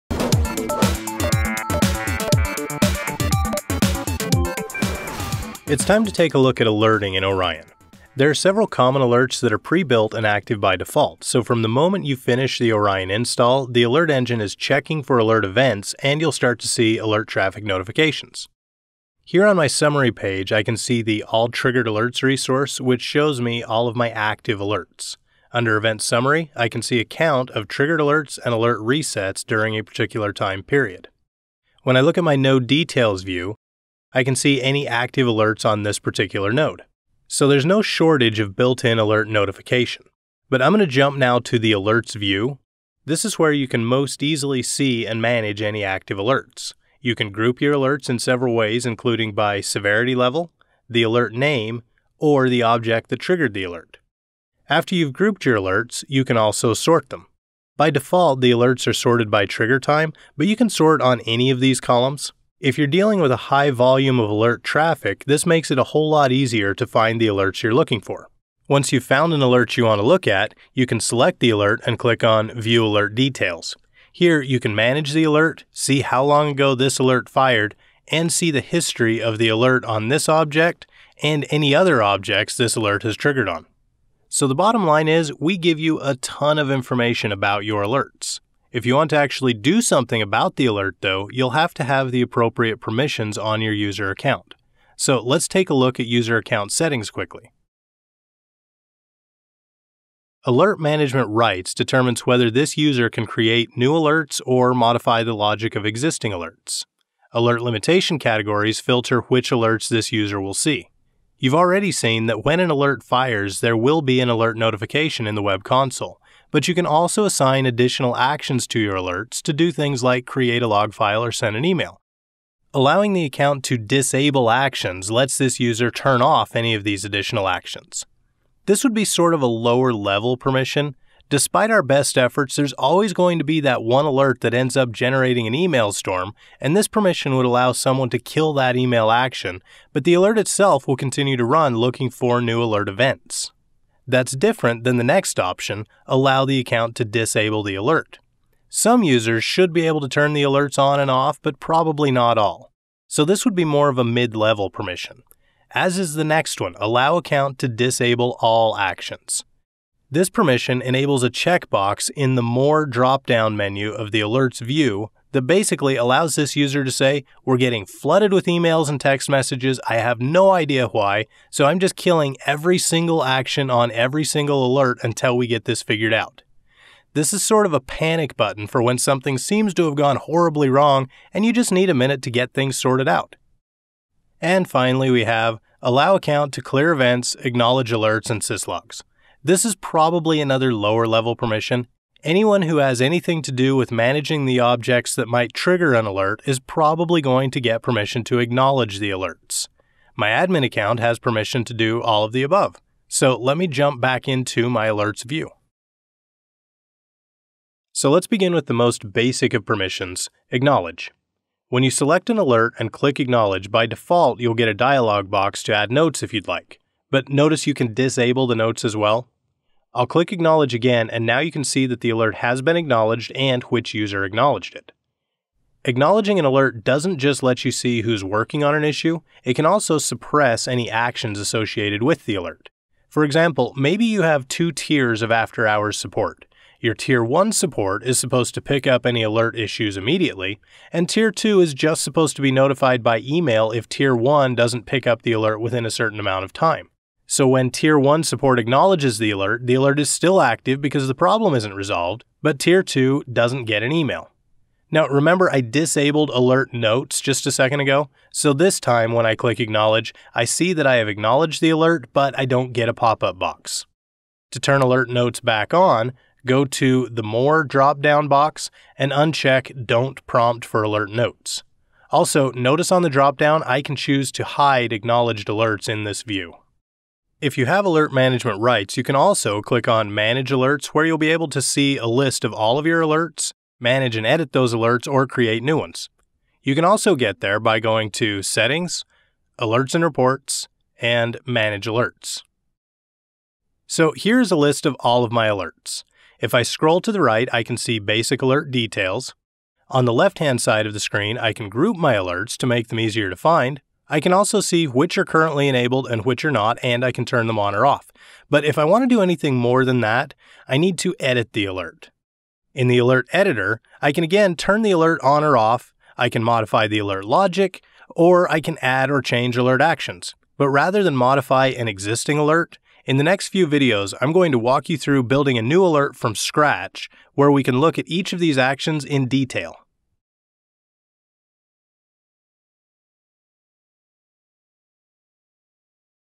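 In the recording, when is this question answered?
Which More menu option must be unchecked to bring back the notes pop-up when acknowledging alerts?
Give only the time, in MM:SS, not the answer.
04:29.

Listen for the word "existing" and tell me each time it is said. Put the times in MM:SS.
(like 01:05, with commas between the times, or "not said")
01:45, 05:21.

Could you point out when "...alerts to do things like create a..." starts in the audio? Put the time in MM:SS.
01:58.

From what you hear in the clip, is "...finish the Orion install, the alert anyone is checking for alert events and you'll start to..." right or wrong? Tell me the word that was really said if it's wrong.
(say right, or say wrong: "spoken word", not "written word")
wrong: "engine", not "anyone".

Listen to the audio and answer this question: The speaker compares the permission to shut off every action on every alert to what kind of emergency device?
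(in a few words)
Panic button.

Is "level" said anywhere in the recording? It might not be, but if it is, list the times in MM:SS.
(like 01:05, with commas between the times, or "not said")
00:50, 02:09, 02:34, 03:11.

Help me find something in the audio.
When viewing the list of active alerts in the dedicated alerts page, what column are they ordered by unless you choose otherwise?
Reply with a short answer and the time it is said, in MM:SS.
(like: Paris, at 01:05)
Trigger time, at 00:59.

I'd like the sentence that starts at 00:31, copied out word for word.
When I look at my Node Details view, I can see any active alerts on this particular node.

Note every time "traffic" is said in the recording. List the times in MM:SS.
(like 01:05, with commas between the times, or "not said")
00:17, 01:04.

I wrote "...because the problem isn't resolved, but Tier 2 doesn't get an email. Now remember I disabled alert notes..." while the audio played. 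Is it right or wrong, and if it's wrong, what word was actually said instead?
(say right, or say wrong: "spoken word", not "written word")
right.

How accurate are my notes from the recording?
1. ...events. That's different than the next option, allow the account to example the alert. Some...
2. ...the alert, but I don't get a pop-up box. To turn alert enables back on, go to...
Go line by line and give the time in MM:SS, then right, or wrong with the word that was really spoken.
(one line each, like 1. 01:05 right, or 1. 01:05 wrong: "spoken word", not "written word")
1. 02:22 wrong: "disable", not "example"
2. 04:21 wrong: "notes", not "enables".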